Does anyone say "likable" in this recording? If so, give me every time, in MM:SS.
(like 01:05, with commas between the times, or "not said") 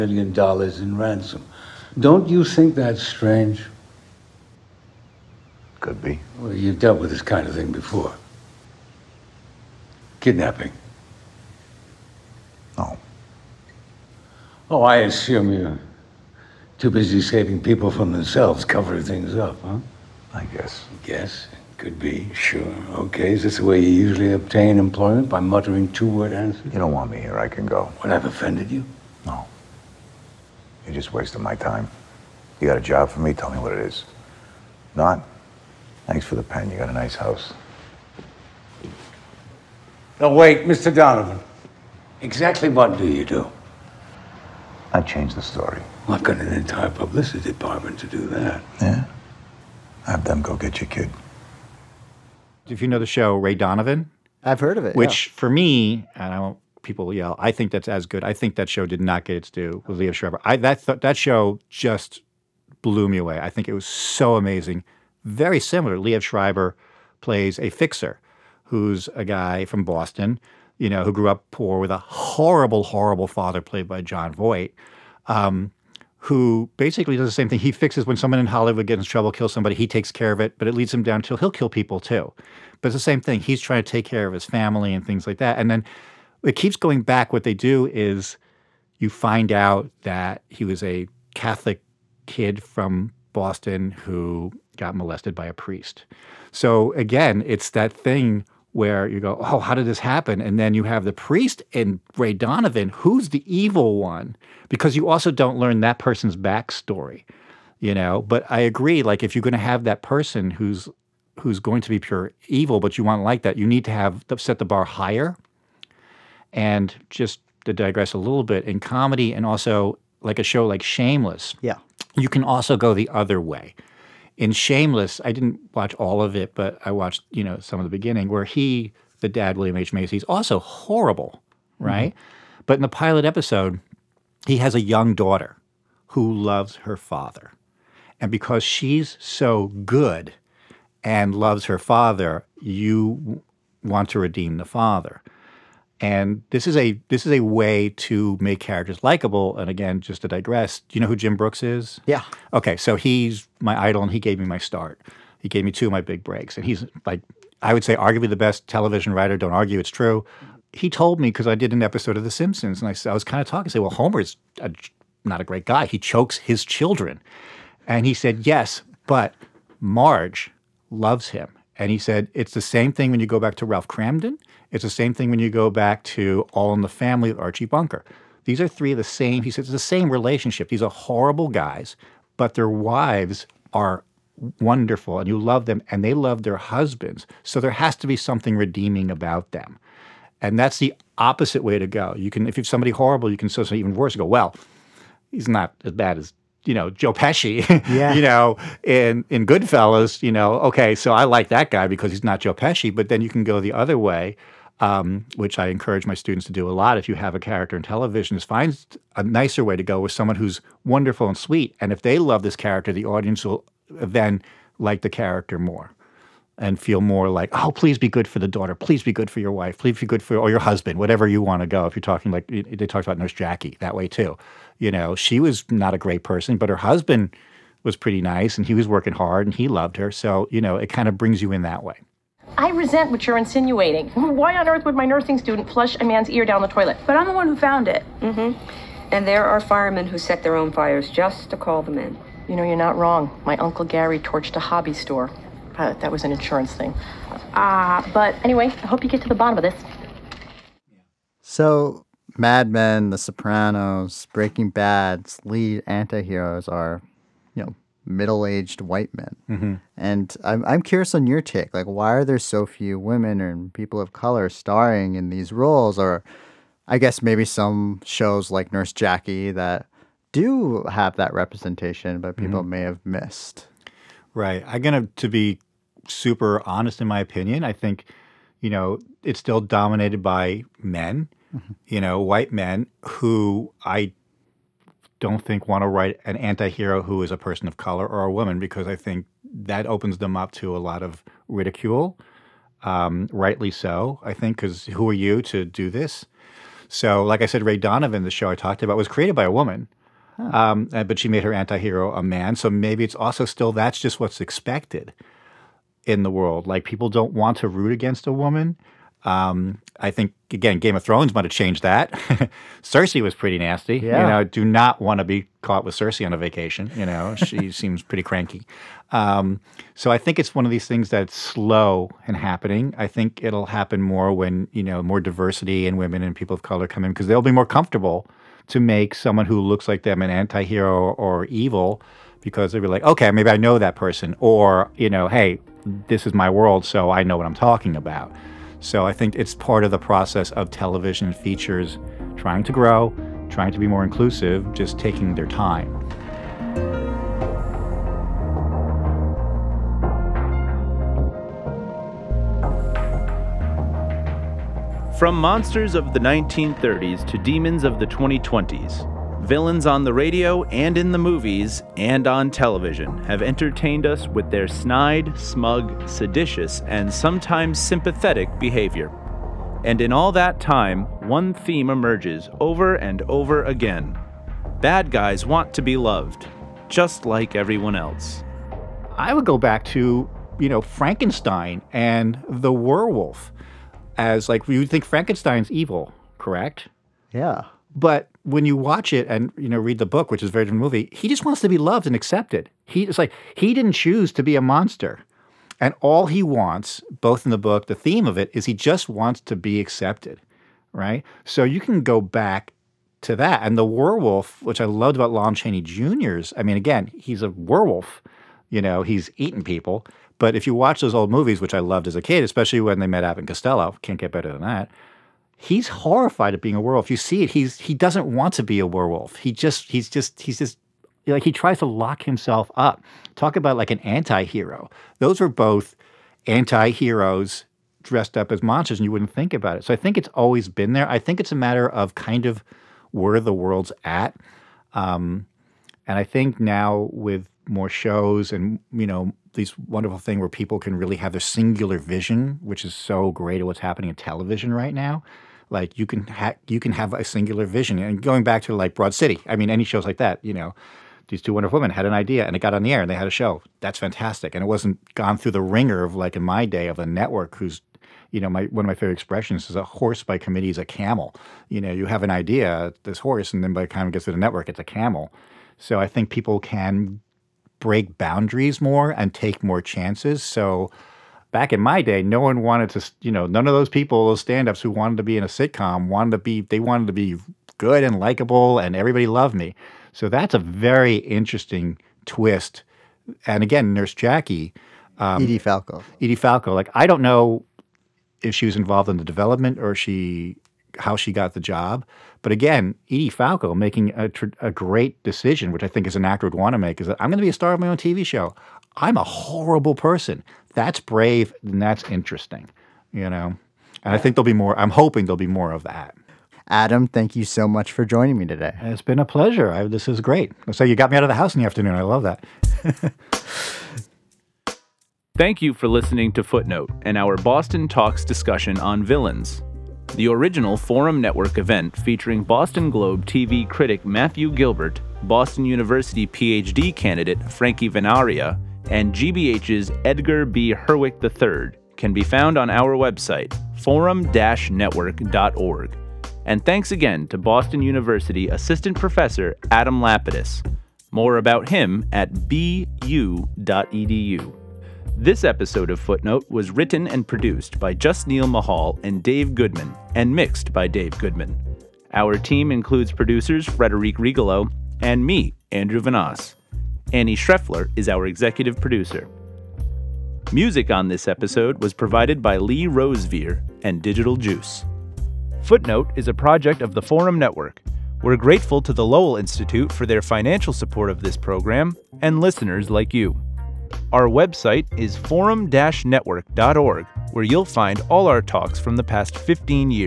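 02:29, 07:58.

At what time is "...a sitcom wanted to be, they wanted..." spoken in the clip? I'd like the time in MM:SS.
07:55.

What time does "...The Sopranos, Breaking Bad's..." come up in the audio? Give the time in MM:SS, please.
04:13.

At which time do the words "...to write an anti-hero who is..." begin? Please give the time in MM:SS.
04:45.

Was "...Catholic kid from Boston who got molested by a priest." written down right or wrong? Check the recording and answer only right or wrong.
right.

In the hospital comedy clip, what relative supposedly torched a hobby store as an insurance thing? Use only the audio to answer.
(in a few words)
Uncle Gary.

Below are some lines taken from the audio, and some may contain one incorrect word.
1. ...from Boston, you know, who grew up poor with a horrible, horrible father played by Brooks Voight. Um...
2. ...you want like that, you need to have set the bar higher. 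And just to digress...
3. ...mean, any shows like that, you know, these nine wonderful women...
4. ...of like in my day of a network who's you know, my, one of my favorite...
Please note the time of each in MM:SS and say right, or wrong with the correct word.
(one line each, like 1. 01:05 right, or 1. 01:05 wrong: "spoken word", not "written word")
1. 01:09 wrong: "Jon", not "Brooks"
2. 01:52 right
3. 07:29 wrong: "two", not "nine"
4. 07:36 right.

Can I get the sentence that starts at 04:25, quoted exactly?
Or, I guess maybe some shows like Nurse Jackie that do have that representation, but people mm-hmm.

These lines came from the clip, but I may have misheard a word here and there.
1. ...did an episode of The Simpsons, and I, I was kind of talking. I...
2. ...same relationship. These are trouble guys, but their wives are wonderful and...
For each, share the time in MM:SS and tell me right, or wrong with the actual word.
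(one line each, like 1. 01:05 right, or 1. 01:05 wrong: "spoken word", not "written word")
1. 02:41 right
2. 02:59 wrong: "horrible", not "trouble".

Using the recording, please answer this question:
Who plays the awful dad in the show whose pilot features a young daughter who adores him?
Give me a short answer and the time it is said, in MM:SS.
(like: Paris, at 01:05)
William H. Macy, at 02:09.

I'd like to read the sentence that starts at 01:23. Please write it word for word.
He's trying to take care of his family and things like that.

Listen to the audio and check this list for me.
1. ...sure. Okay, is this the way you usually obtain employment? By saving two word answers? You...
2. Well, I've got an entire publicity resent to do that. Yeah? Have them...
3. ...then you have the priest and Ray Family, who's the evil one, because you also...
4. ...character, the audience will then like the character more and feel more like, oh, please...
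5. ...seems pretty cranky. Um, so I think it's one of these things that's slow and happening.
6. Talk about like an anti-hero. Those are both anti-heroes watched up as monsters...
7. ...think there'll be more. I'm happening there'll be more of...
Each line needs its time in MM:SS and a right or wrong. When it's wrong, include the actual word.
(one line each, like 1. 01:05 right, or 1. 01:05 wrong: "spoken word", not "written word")
1. 00:22 wrong: "muttering", not "saving"
2. 00:46 wrong: "department", not "resent"
3. 01:40 wrong: "Donovan", not "Family"
4. 03:32 right
5. 05:17 right
6. 07:03 wrong: "dressed", not "watched"
7. 08:24 wrong: "hoping", not "happening".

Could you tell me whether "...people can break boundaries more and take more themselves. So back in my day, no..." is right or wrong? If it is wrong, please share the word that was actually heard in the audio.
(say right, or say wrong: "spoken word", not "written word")
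wrong: "chances", not "themselves".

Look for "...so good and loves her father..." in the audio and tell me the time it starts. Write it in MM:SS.
02:19.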